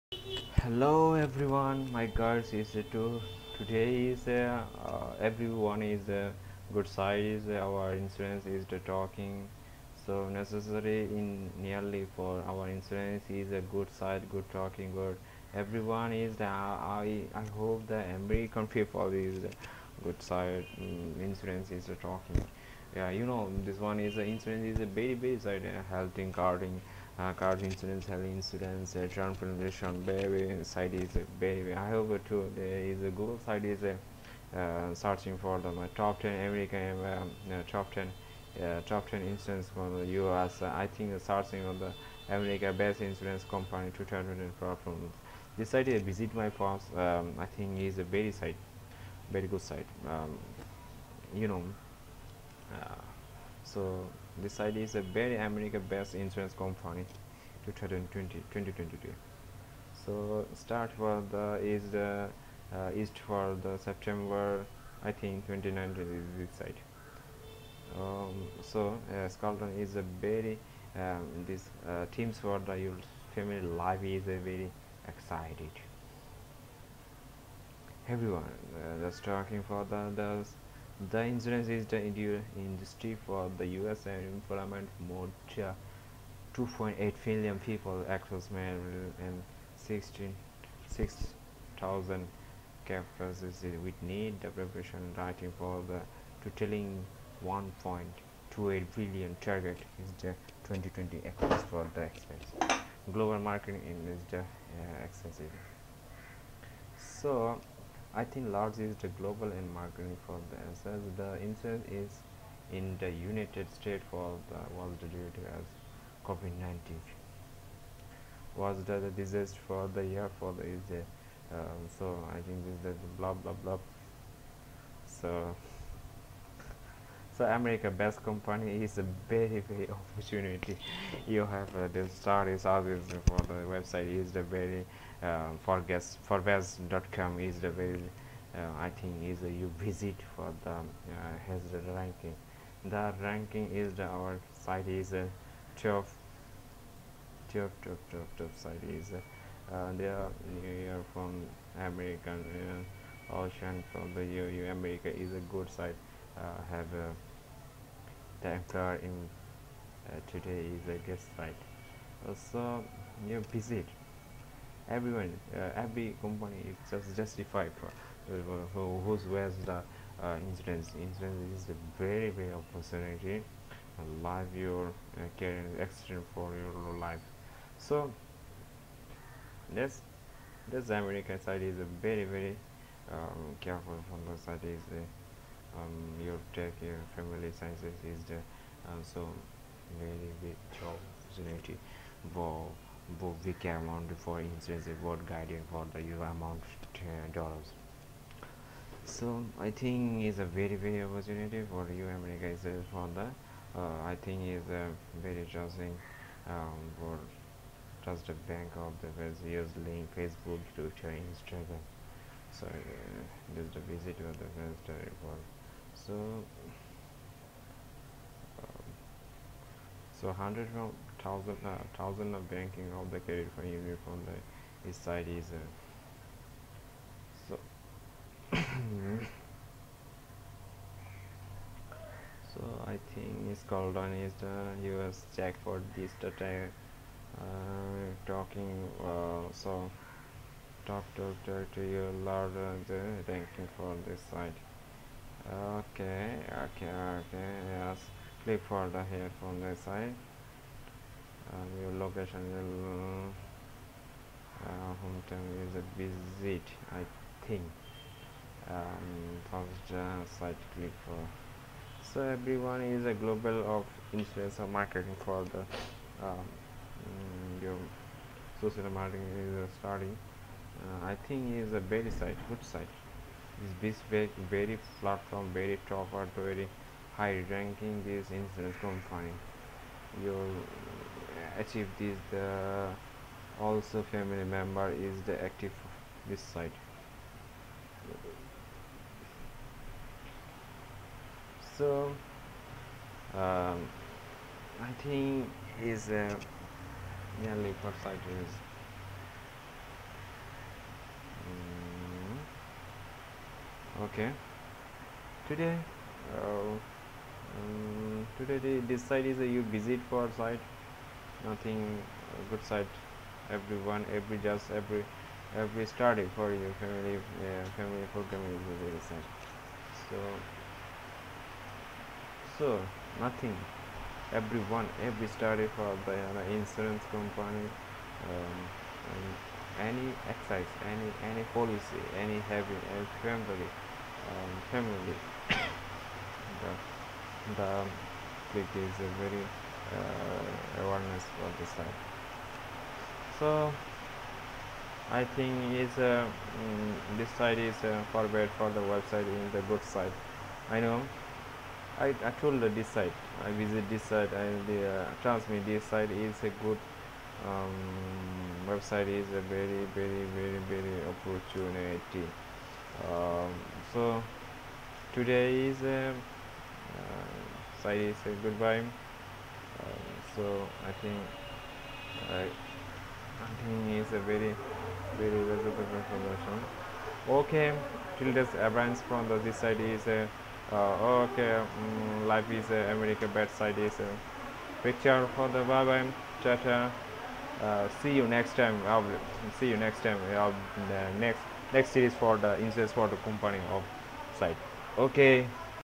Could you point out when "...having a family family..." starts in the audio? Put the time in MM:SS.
05:32.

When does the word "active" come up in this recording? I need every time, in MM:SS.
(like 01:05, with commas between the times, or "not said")
04:45.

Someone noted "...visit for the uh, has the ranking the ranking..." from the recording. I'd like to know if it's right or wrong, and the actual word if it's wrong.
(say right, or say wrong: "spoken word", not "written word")
right.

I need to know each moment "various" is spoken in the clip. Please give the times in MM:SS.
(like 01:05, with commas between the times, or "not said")
03:29.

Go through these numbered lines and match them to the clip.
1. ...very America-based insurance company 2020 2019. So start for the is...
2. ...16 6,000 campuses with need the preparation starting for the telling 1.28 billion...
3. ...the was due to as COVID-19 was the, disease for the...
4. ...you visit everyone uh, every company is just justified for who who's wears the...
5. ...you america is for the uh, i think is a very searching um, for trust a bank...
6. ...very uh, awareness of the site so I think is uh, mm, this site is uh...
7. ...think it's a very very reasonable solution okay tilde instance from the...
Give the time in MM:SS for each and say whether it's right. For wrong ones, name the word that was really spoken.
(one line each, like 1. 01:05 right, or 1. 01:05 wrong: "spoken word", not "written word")
1. 00:55 wrong: "2022", not "2019"
2. 01:29 wrong: "writing", not "starting"
3. 01:54 right
4. 02:43 right
5. 03:21 wrong: "interesting", not "searching"
6. 05:39 right
7. 06:13 wrong: "advance", not "instance".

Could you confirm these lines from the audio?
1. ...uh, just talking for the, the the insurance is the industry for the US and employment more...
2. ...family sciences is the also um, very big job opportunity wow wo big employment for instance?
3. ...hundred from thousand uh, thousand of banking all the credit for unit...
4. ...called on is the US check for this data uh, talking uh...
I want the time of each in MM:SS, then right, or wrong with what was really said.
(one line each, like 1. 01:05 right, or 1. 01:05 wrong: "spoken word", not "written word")
1. 01:18 right
2. 03:07 wrong: "amount", not "employment"
3. 03:40 right
4. 03:53 right.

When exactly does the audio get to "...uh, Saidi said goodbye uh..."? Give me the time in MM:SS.
06:06.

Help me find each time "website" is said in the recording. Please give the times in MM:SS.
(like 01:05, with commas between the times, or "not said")
02:13, 03:34, 05:48, 05:58.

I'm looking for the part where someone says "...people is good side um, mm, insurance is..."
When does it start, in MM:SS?
00:18.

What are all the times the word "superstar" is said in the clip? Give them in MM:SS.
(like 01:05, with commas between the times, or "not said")
not said.